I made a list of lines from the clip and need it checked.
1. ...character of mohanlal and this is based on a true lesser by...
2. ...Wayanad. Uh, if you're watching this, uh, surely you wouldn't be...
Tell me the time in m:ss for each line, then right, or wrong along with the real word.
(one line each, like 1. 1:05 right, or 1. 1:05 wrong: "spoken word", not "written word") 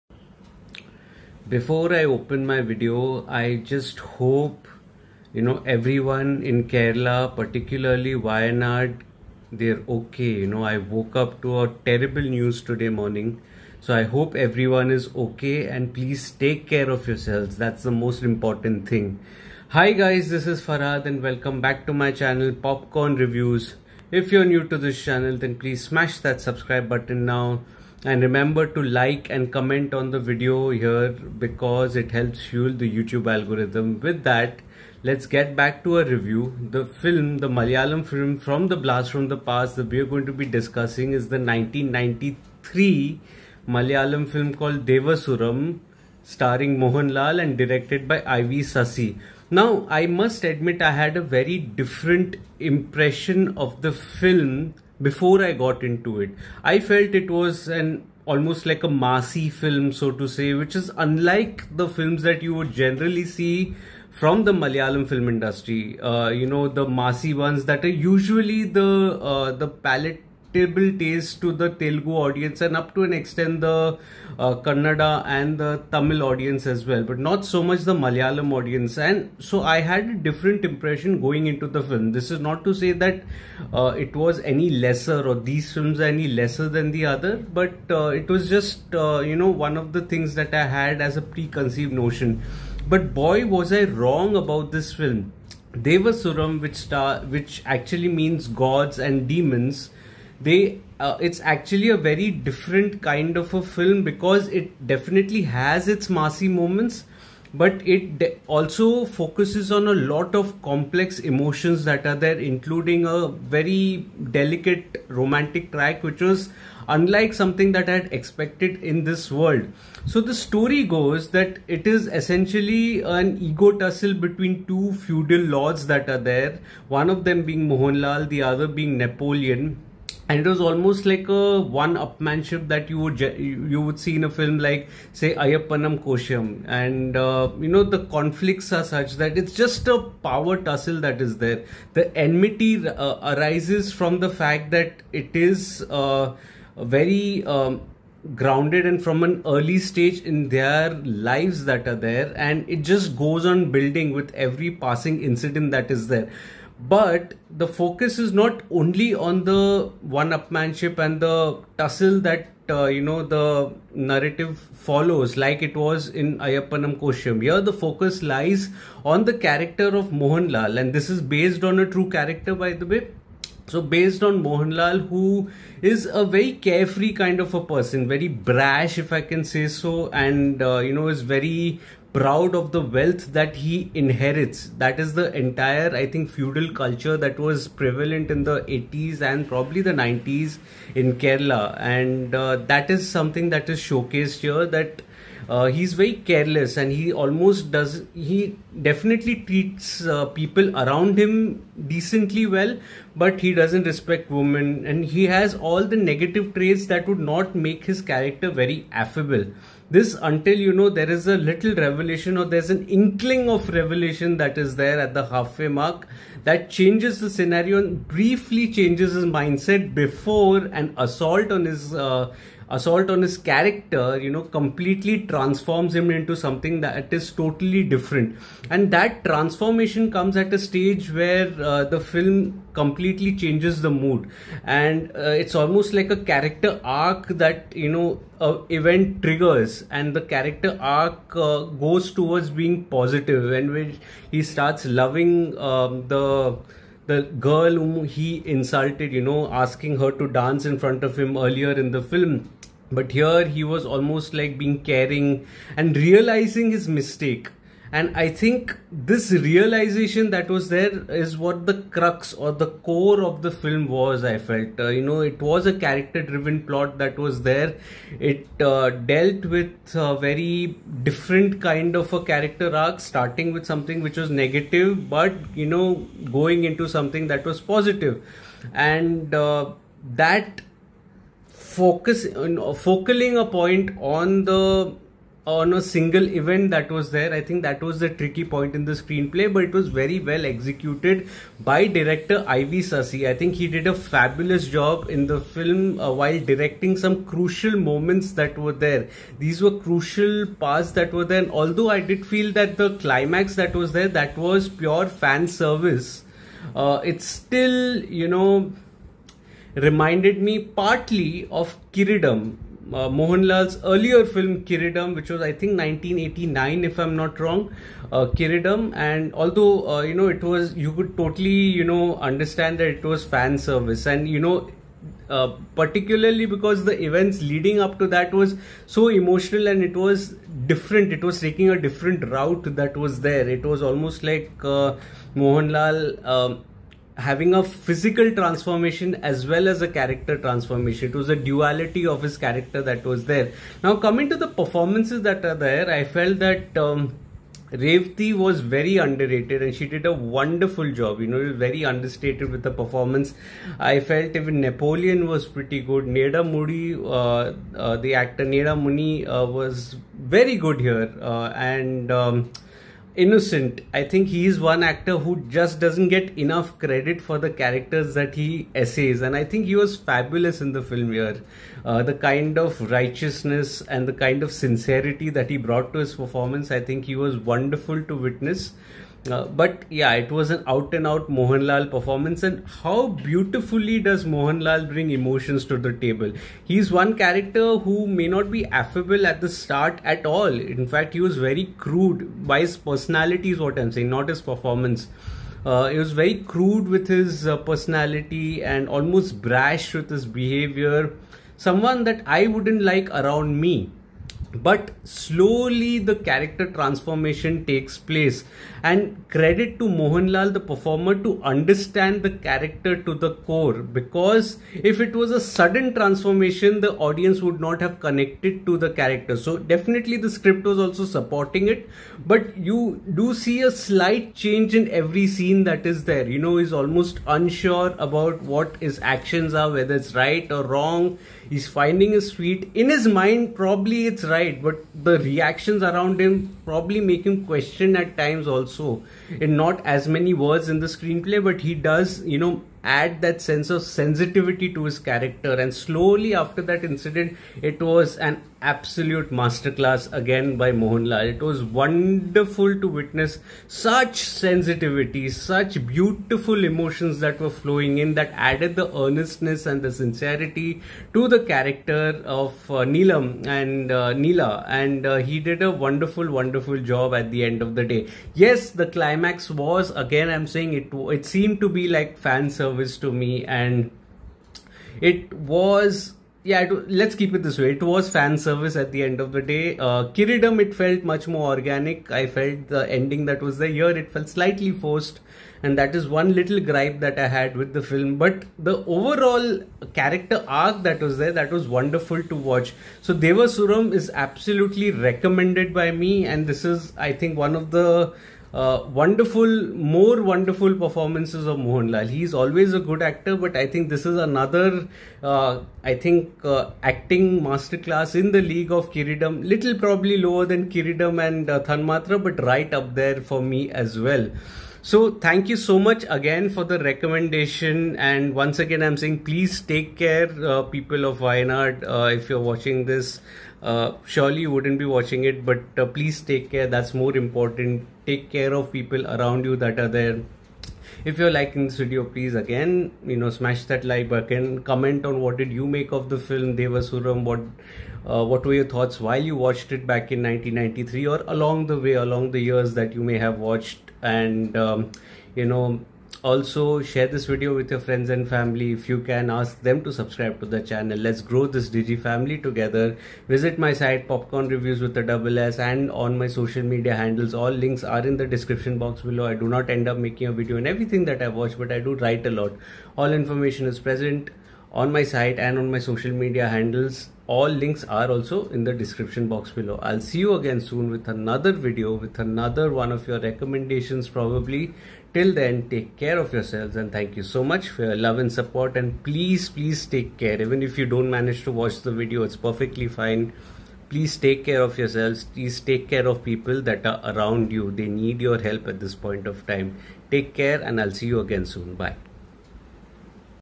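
1. 2:49 wrong: "character", not "lesser"
2. 8:41 right.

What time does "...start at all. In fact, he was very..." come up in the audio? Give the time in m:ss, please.
6:29.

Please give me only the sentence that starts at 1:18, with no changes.
And so I had a different impression going into the film.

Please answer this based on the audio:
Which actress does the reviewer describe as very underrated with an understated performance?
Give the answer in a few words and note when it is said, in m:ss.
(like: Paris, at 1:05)
Revathi, at 5:47.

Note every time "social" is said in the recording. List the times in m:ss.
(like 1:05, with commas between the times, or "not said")
9:16, 9:25.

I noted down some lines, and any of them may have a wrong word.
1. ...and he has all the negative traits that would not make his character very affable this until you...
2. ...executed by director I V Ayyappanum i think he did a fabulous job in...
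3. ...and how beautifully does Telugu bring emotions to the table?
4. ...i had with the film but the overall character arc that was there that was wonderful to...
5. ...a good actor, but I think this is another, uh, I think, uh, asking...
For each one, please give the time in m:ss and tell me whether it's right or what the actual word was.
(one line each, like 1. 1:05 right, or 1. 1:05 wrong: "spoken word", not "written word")
1. 3:24 right
2. 4:50 wrong: "Sasi", not "Ayyappanum"
3. 6:22 wrong: "Mohanlal", not "Telugu"
4. 8:07 right
5. 8:22 wrong: "acting", not "asking".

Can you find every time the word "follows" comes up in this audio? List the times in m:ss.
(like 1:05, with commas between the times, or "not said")
2:44.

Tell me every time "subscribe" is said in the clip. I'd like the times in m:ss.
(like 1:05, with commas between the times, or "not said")
0:26, 9:09.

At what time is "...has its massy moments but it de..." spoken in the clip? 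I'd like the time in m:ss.
1:45.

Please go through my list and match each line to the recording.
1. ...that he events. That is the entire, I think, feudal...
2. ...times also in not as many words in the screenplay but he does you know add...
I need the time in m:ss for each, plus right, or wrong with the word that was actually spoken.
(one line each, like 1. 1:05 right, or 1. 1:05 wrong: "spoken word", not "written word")
1. 3:03 wrong: "inherits", not "events"
2. 7:18 right.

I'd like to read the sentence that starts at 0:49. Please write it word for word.
Now, I must admit I had a very different impression of the film before I got into it.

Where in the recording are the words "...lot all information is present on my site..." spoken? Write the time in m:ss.
9:22.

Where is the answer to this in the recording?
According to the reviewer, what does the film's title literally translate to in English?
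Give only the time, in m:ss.
1:38.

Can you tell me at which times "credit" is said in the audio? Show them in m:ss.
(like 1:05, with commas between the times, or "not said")
6:06, 6:49.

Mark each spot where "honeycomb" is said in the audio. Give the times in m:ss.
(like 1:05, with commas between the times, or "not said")
not said.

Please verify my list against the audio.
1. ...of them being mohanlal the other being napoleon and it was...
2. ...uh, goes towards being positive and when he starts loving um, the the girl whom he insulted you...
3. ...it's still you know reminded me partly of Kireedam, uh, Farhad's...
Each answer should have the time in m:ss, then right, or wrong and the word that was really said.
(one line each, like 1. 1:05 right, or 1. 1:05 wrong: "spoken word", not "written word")
1. 2:07 right
2. 4:01 right
3. 5:07 wrong: "Mohanlal", not "Farhad".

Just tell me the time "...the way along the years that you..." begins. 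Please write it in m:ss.
9:01.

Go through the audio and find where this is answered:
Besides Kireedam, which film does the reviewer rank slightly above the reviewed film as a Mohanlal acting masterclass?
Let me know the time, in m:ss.
8:31.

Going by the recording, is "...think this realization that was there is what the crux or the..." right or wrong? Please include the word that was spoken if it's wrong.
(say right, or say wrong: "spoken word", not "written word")
right.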